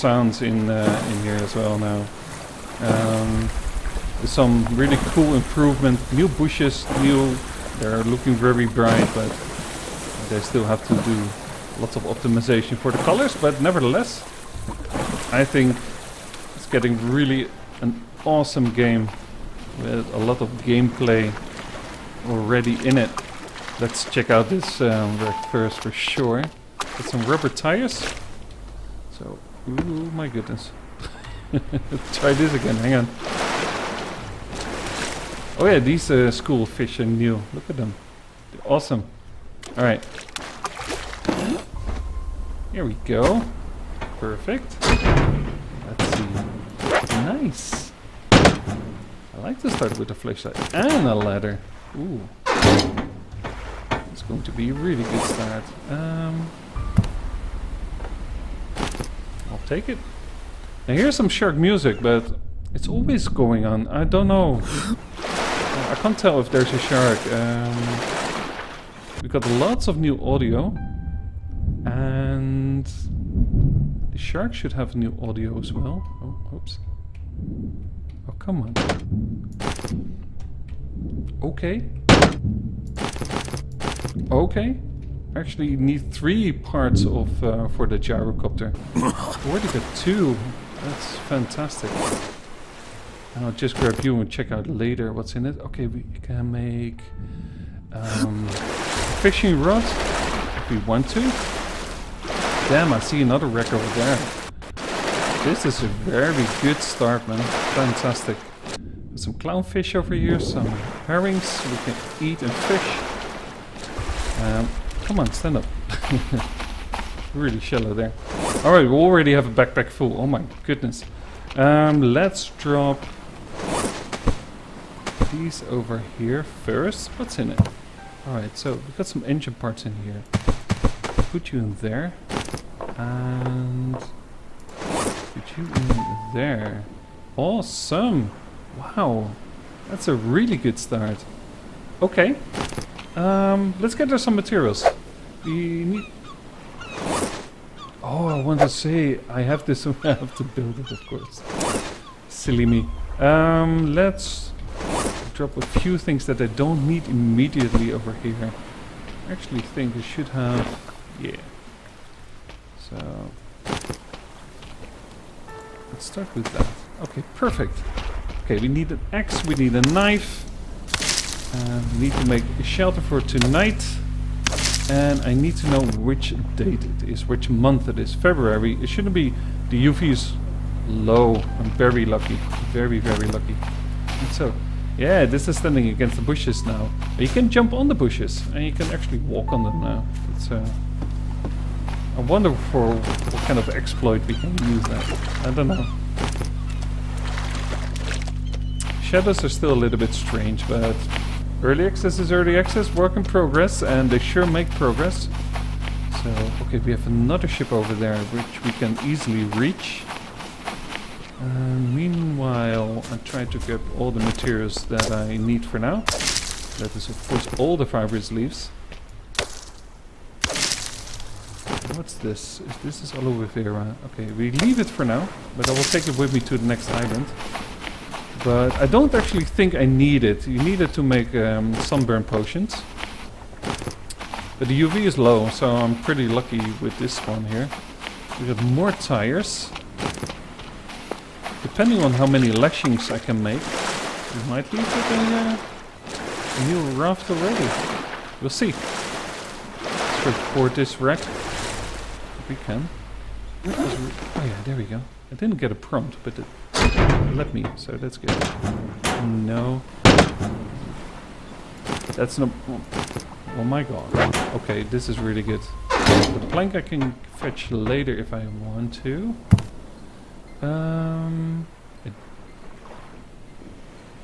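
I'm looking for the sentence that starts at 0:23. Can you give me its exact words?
Let's check out this um, work first for sure.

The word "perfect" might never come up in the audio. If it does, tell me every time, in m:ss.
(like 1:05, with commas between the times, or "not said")
0:44, 2:47.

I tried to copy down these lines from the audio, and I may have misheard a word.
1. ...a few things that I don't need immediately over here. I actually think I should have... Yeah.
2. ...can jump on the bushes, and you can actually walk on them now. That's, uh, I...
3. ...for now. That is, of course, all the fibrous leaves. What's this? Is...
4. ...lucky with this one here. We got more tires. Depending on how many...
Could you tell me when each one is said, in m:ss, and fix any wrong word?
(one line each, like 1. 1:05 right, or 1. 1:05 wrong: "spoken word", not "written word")
1. 2:35 right
2. 3:07 right
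3. 3:35 right
4. 3:56 right.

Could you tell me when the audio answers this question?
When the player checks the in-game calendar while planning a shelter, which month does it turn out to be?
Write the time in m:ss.
2:58.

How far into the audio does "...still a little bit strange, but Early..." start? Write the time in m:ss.
3:19.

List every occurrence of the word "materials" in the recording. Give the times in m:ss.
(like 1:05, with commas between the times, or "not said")
2:24, 3:34.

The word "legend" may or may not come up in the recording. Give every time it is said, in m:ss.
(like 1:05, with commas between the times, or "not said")
not said.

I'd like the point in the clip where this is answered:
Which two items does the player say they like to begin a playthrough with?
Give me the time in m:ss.
0:50.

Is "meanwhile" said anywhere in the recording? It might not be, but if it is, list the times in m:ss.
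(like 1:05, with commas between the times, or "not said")
3:31.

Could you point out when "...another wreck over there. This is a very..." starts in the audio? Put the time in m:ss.
1:43.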